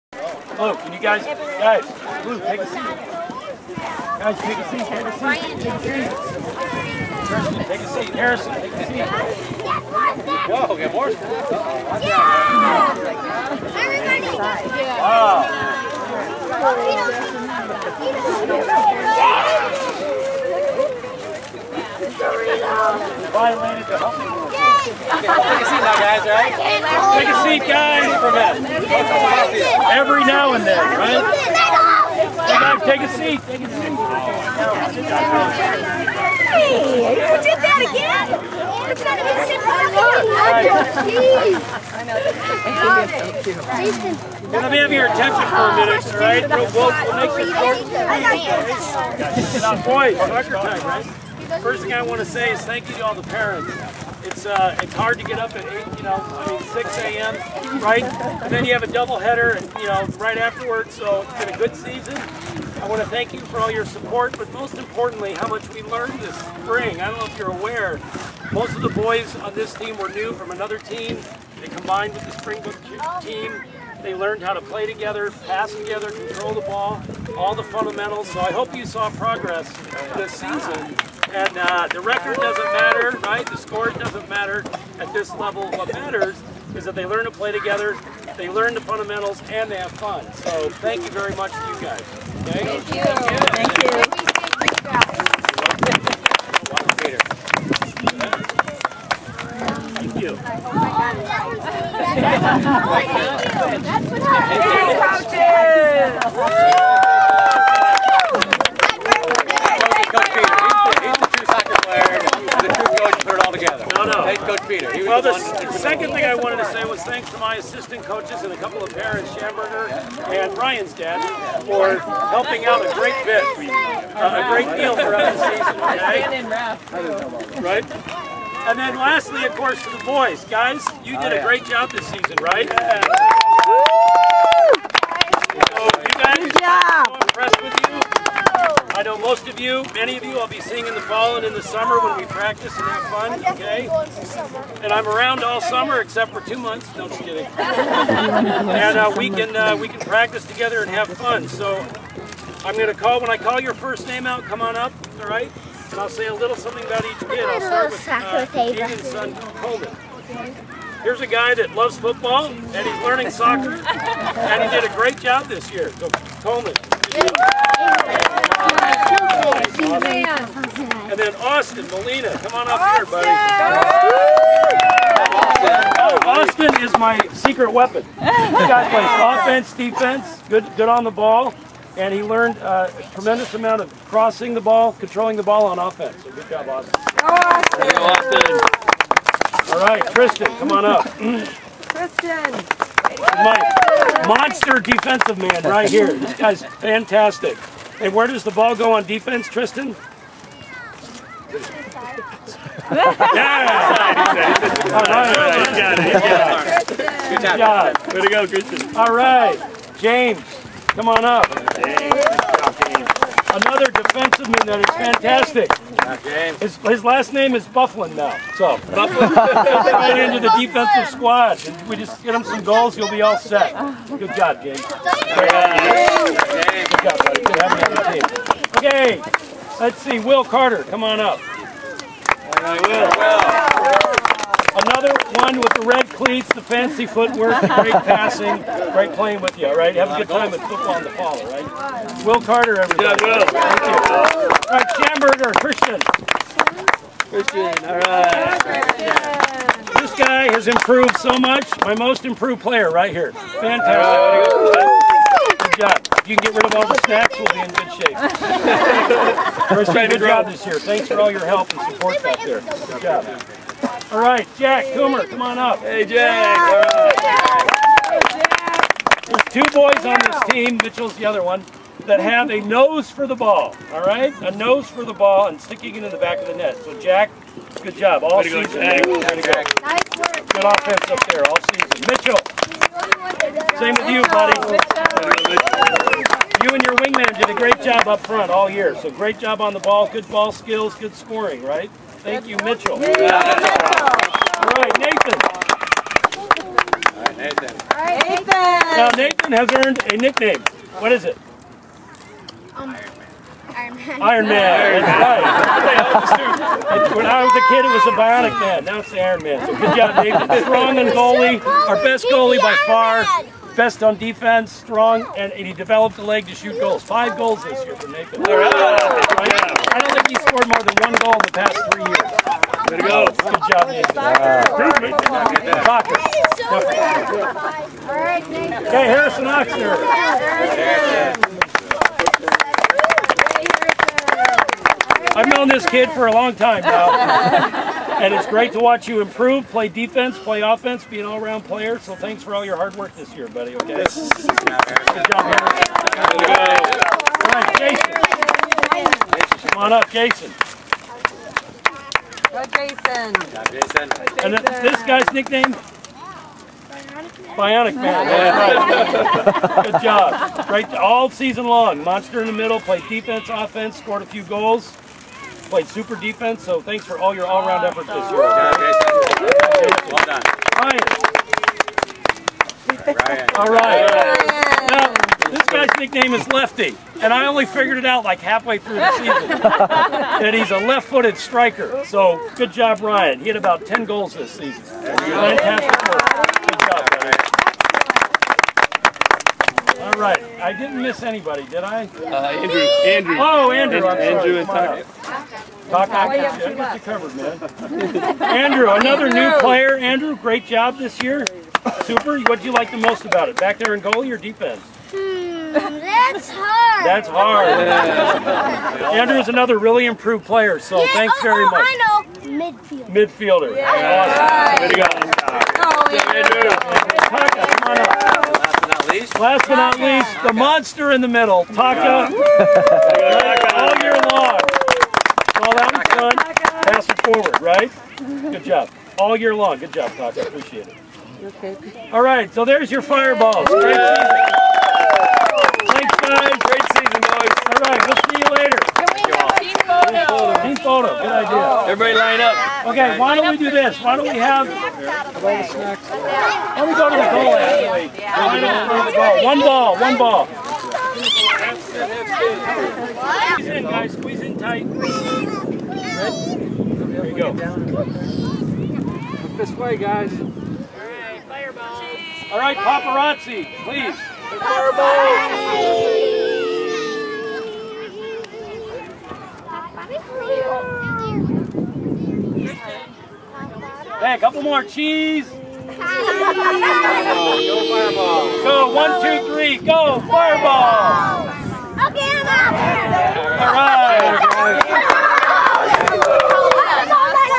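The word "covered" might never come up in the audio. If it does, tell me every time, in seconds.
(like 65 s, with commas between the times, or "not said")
397 s.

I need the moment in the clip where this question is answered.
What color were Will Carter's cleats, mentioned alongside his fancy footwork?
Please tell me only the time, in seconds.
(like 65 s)
235 s.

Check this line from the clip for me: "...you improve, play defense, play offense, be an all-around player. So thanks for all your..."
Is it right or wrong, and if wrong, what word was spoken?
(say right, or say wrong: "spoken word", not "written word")
right.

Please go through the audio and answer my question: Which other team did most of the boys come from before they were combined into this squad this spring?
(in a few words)
Springbrook.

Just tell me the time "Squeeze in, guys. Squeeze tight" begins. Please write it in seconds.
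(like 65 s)
453 s.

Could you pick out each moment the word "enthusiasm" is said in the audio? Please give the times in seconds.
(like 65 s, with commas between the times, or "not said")
not said.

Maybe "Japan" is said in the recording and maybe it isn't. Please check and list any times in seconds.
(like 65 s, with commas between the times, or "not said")
not said.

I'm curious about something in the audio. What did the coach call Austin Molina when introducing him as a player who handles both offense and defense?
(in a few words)
Secret weapon.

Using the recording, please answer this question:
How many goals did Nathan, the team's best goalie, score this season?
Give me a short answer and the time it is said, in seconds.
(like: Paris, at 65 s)
5, at 317 s.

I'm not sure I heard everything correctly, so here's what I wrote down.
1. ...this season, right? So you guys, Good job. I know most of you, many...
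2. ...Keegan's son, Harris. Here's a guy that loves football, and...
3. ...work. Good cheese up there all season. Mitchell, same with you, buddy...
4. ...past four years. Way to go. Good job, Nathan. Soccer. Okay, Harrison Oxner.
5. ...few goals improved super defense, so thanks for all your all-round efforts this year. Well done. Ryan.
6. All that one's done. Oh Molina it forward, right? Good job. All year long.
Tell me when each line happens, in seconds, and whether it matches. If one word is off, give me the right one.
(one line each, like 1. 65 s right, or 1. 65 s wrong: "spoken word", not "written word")
1. 131 s right
2. 158 s wrong: "Coleman", not "Harris"
3. 280 s wrong: "offense", not "cheese"
4. 321 s wrong: "three", not "four"
5. 364 s wrong: "played", not "improved"
6. 425 s wrong: "Pass", not "Molina".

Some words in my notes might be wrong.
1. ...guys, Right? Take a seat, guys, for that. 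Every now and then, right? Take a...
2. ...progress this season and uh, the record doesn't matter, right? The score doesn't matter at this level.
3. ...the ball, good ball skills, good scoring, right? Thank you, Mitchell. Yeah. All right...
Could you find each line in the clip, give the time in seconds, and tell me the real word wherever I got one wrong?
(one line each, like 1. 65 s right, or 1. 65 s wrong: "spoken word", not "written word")
1. 25 s right
2. 79 s right
3. 289 s right.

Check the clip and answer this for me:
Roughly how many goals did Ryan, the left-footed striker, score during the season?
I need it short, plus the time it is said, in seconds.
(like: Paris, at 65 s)
10, at 383 s.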